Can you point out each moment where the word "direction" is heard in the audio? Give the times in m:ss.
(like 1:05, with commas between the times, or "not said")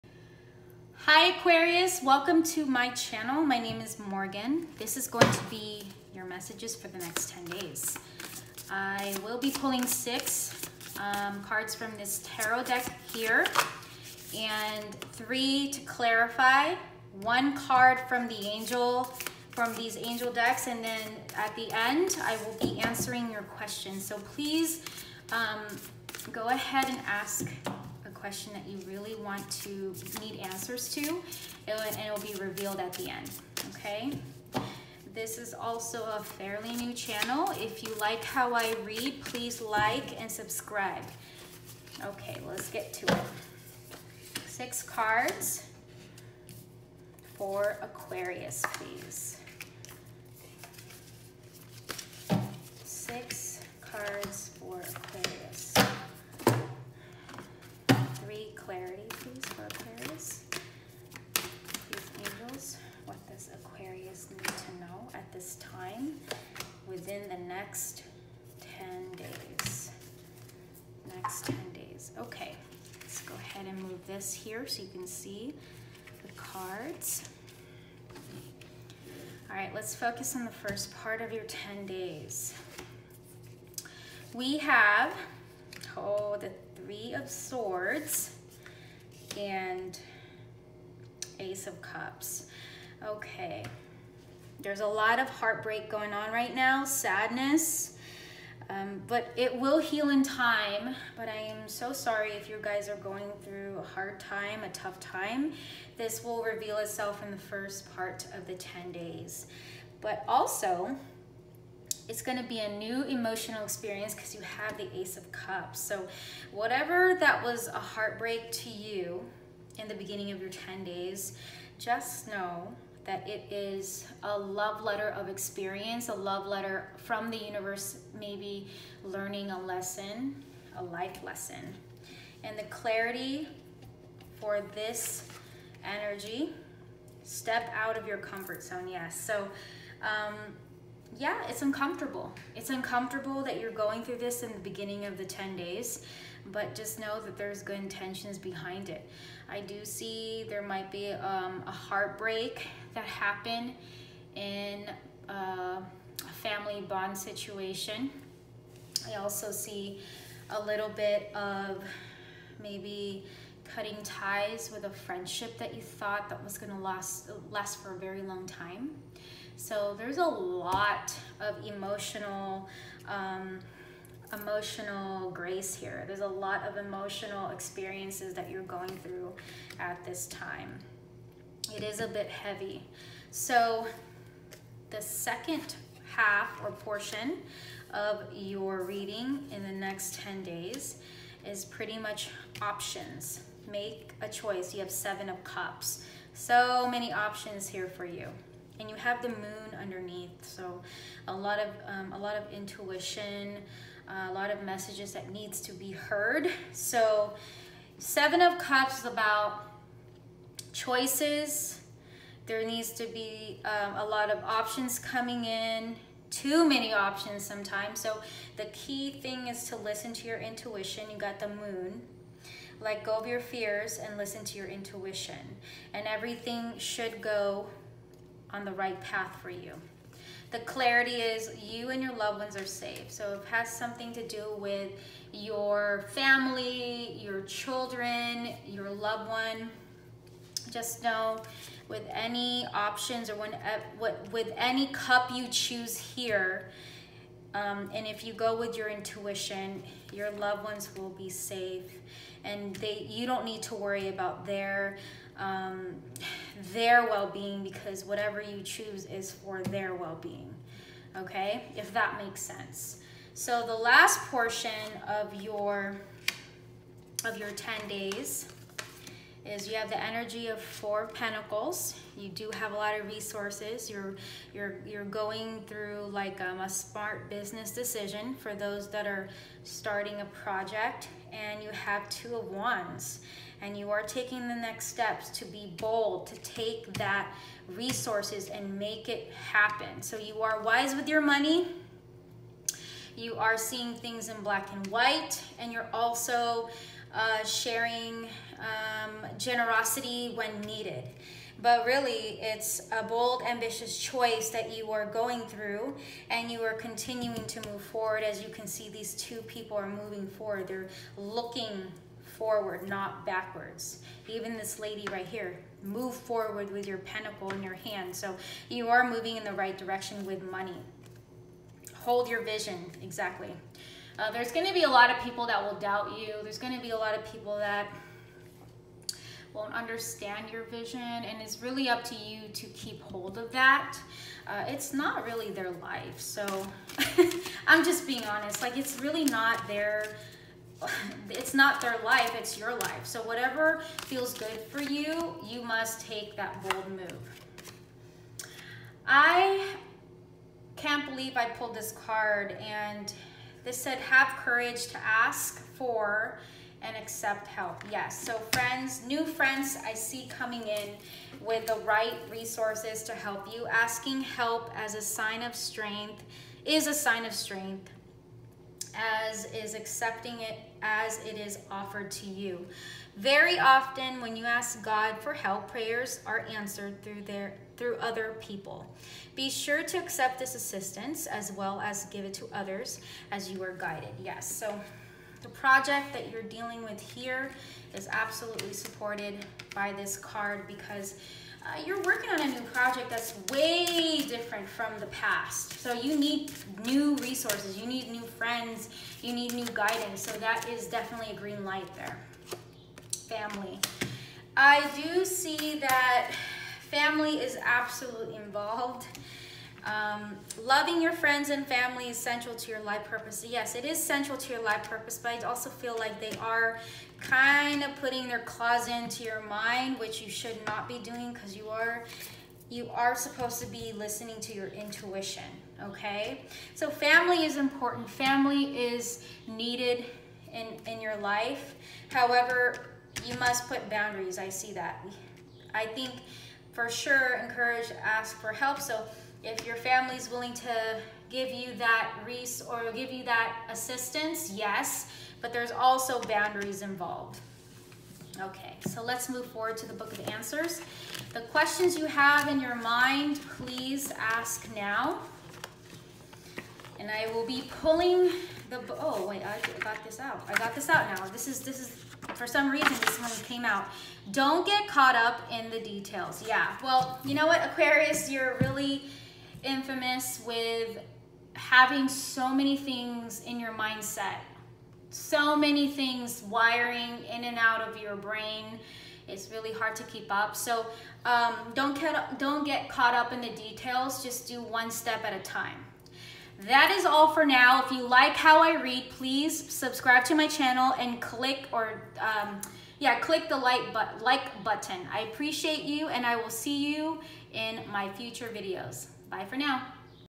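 5:19.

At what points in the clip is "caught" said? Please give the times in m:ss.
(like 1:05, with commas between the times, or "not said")
7:44, 8:02.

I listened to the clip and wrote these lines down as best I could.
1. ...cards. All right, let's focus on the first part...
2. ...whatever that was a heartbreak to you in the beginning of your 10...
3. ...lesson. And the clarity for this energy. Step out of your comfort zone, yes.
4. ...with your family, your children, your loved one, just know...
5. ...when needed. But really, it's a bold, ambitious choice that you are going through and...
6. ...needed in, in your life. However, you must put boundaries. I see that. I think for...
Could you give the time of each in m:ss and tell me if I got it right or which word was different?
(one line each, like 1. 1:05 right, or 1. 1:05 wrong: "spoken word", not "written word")
1. 1:16 right
2. 1:56 right
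3. 2:11 right
4. 3:54 right
5. 5:00 right
6. 7:09 right.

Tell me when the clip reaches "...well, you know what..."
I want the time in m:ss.
7:46.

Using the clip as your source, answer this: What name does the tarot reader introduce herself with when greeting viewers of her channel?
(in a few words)
Morgan.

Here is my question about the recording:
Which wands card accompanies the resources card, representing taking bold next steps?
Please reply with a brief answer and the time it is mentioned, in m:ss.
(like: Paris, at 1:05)
Two of Wands, at 4:42.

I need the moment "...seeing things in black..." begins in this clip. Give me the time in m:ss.
4:53.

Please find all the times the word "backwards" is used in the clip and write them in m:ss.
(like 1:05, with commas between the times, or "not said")
5:13.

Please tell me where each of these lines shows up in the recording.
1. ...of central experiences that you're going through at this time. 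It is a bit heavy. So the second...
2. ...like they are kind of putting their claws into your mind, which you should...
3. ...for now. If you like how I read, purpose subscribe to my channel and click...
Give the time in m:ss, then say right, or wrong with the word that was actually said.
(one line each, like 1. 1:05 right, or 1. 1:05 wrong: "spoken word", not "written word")
1. 2:56 wrong: "emotional", not "central"
2. 6:55 right
3. 8:07 wrong: "please", not "purpose".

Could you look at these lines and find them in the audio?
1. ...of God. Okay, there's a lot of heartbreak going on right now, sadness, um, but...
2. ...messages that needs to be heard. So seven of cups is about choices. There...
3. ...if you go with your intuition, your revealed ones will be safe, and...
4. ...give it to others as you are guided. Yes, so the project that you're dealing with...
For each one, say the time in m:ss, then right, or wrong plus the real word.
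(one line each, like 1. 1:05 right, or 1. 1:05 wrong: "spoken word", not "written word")
1. 1:31 wrong: "Cups", not "God"
2. 3:24 right
3. 4:08 wrong: "loved", not "revealed"
4. 6:22 right.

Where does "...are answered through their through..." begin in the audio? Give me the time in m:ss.
6:16.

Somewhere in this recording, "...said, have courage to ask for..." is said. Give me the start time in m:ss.
5:53.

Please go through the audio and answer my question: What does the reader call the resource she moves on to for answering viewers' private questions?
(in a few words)
The Book of Answers.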